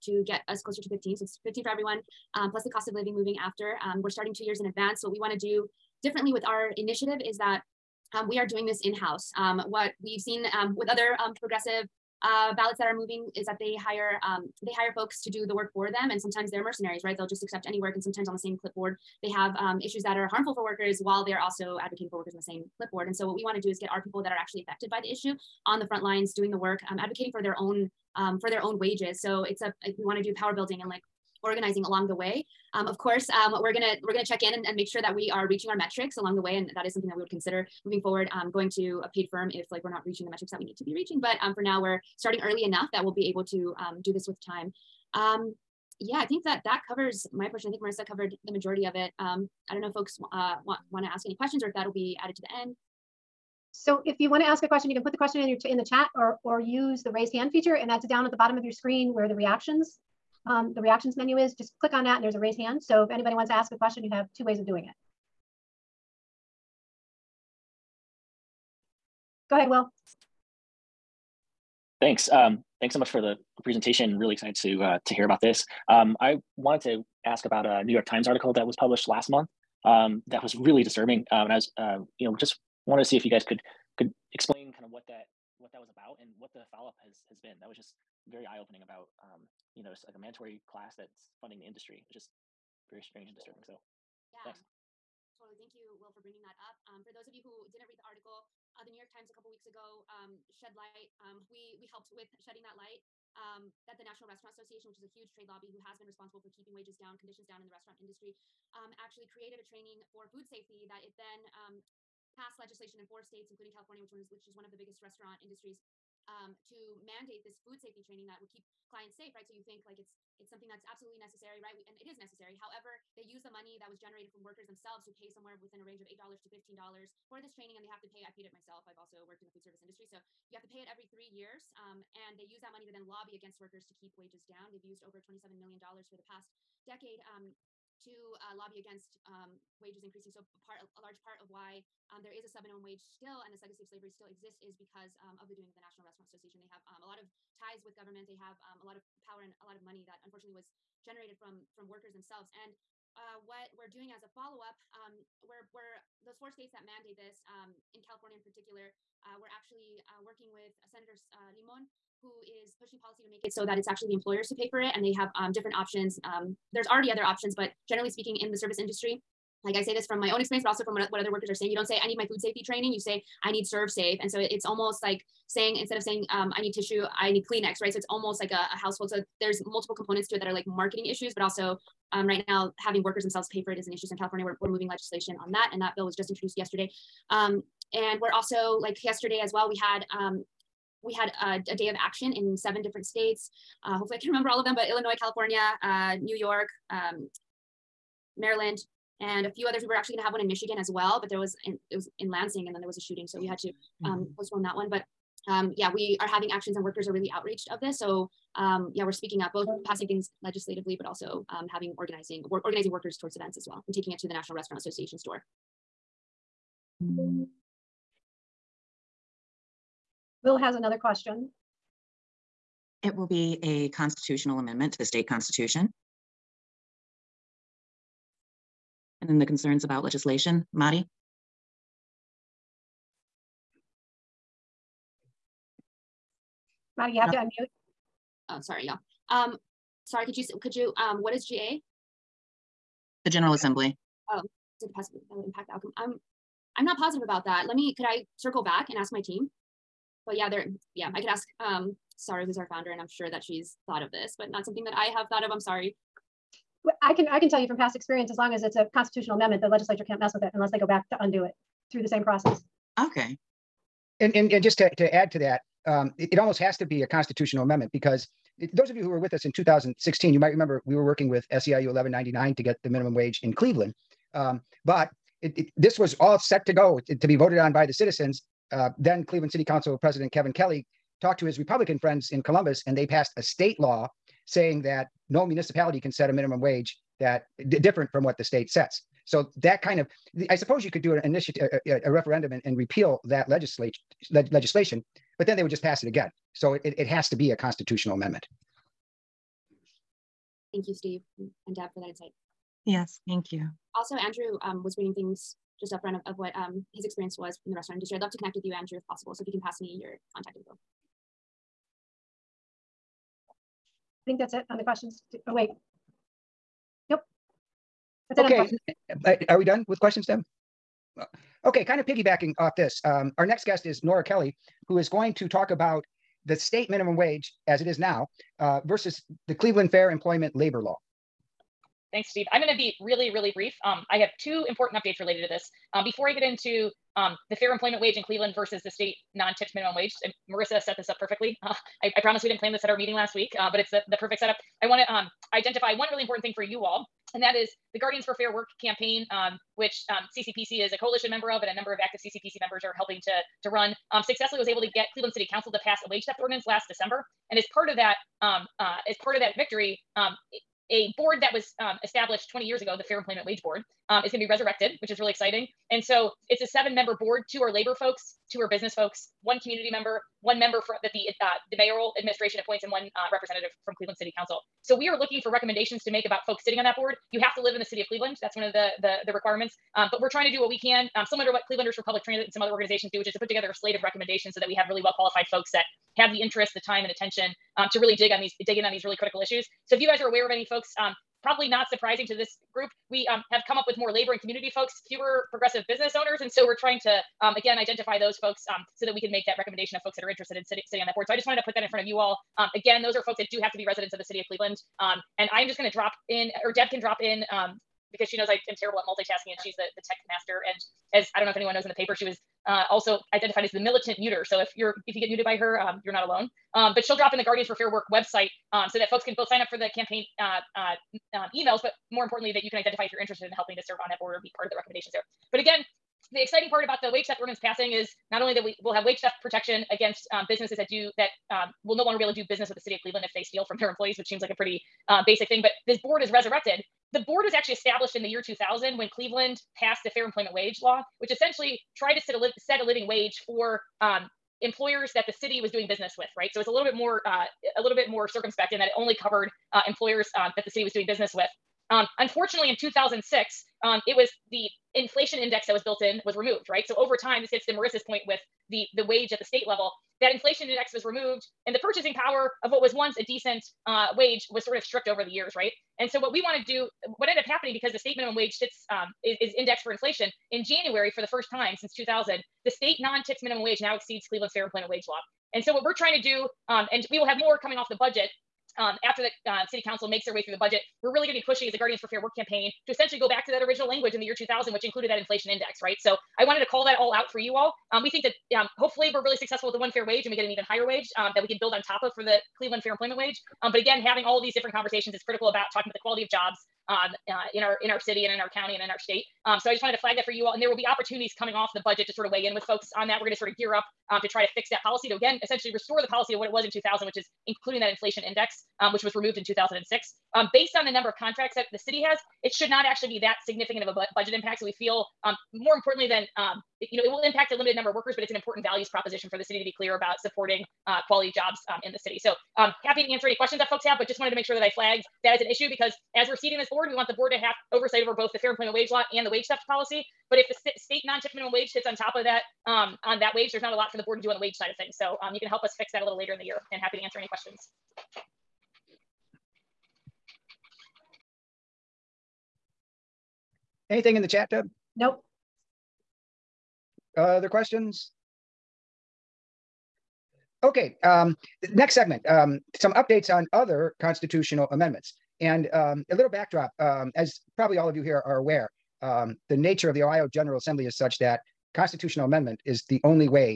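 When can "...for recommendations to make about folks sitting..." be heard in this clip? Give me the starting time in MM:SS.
06:15.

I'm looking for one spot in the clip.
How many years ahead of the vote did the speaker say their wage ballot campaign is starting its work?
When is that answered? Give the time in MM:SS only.
00:04.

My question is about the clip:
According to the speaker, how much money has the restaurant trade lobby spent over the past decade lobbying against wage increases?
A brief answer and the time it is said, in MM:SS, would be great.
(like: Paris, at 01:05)
$27 million, at 02:15.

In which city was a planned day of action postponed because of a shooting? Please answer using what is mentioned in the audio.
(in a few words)
Lansing.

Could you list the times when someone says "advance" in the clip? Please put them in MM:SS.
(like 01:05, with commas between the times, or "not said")
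00:04.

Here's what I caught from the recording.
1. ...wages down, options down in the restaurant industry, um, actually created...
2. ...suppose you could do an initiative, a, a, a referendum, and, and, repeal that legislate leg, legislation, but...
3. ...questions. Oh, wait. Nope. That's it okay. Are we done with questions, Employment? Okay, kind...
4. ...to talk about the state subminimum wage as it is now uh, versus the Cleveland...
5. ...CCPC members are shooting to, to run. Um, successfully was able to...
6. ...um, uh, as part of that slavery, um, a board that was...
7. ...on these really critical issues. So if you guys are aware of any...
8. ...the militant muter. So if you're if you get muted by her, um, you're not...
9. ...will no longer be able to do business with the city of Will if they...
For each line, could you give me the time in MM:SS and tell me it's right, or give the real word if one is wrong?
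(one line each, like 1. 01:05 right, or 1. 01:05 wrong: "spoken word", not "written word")
1. 01:46 wrong: "conditions", not "options"
2. 04:50 right
3. 05:14 wrong: "Deb", not "Employment"
4. 05:25 wrong: "minimum", not "subminimum"
5. 05:52 wrong: "helping", not "shooting"
6. 05:58 wrong: "victory", not "slavery"
7. 06:28 right
8. 06:53 right
9. 07:11 wrong: "Cleveland", not "Will".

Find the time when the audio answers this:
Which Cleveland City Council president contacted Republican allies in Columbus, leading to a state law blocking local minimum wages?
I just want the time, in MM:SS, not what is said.
04:40.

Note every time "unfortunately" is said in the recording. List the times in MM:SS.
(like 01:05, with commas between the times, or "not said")
02:30, 07:32.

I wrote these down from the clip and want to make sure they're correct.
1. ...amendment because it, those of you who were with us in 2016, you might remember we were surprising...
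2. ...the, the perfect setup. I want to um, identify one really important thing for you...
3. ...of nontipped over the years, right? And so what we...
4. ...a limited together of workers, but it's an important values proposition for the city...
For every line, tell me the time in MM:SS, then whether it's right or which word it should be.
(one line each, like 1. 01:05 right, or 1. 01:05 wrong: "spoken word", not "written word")
1. 04:27 wrong: "working", not "surprising"
2. 05:43 right
3. 07:44 wrong: "stripped", not "nontipped"
4. 08:37 wrong: "number", not "together".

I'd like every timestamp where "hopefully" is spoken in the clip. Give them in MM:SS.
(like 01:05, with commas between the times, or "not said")
03:13, 08:08.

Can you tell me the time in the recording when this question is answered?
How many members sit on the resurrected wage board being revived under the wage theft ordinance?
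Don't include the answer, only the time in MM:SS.
06:06.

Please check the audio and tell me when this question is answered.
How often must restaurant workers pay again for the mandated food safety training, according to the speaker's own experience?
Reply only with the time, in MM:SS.
02:10.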